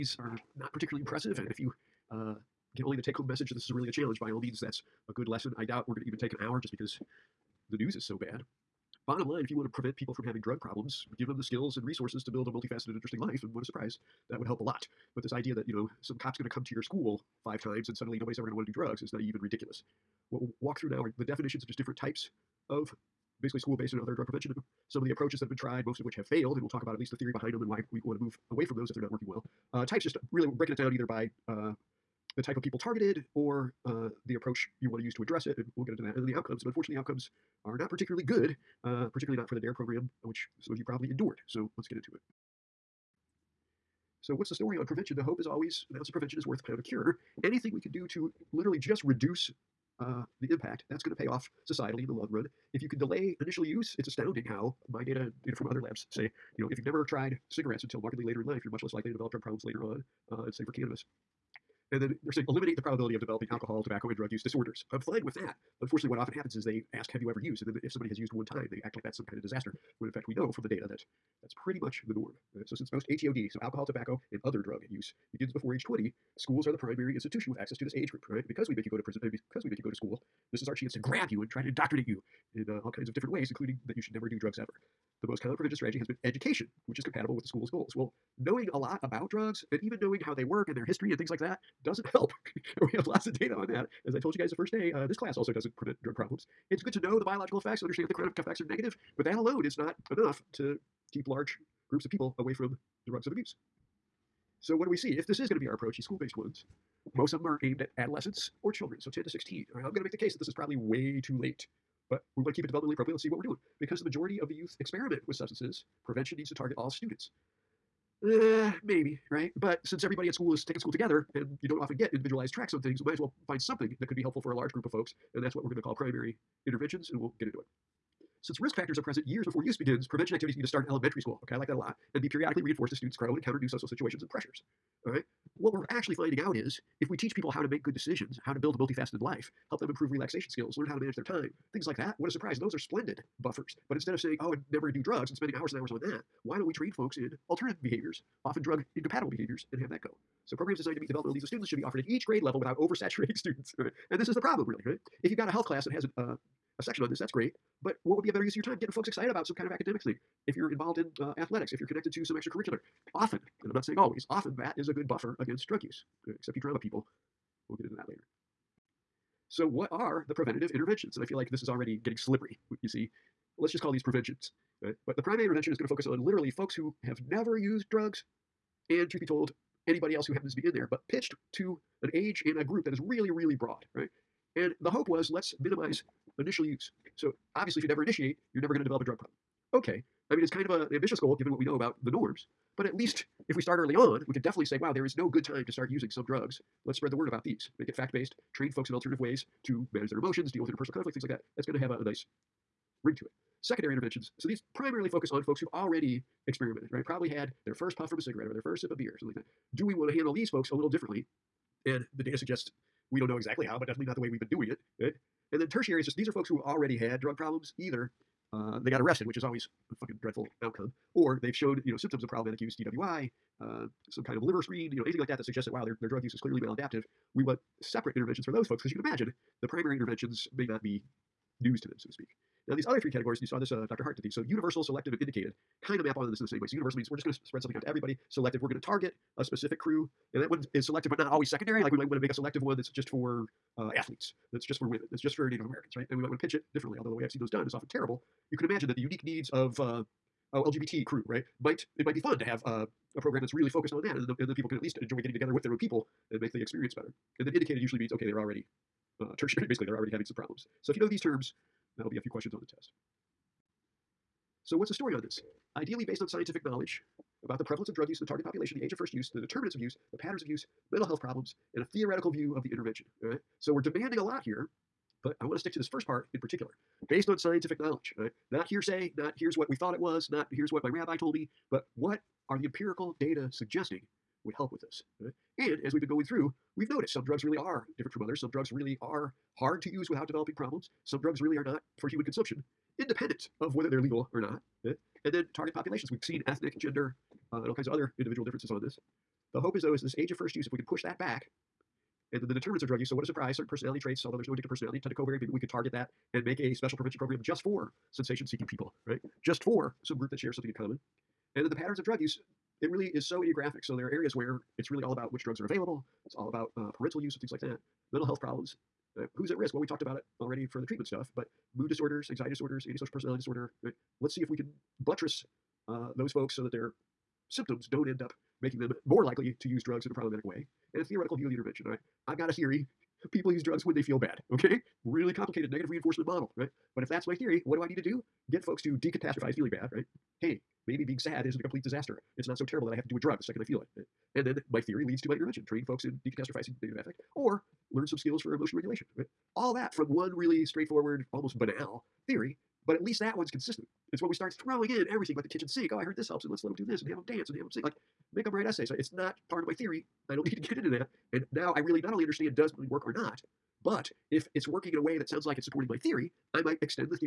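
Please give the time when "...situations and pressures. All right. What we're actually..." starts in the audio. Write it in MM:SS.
02:13.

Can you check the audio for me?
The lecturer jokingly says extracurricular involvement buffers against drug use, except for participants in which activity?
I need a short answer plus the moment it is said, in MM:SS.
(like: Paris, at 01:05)
Drama, at 02:46.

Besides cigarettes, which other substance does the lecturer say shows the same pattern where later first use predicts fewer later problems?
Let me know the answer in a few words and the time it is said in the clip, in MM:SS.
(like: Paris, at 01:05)
Cannabis, at 01:00.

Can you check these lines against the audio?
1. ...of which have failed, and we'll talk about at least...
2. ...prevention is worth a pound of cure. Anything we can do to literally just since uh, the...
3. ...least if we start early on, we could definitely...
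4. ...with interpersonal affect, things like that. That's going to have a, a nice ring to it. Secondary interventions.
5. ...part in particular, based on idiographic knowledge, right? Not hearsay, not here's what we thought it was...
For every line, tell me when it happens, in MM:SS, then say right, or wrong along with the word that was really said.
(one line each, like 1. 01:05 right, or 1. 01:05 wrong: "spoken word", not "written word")
1. 00:25 right
2. 00:46 wrong: "reduce", not "since"
3. 03:12 right
4. 03:20 wrong: "conflict", not "affect"
5. 04:36 wrong: "scientific", not "idiographic".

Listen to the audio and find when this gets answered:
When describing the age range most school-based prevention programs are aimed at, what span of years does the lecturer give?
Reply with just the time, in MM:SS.
01:49.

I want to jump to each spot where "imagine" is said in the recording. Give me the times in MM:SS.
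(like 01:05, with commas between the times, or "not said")
03:48, 04:08.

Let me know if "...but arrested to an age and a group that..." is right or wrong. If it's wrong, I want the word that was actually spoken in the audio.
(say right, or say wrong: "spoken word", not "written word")
wrong: "pitched", not "arrested".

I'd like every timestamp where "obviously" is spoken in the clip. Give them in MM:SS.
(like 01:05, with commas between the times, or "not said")
03:07.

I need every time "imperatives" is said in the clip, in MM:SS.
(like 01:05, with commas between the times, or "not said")
not said.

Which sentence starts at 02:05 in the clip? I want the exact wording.
And that's what we're going to call primary interventions, and we'll get into it.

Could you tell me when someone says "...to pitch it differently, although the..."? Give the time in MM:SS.
04:06.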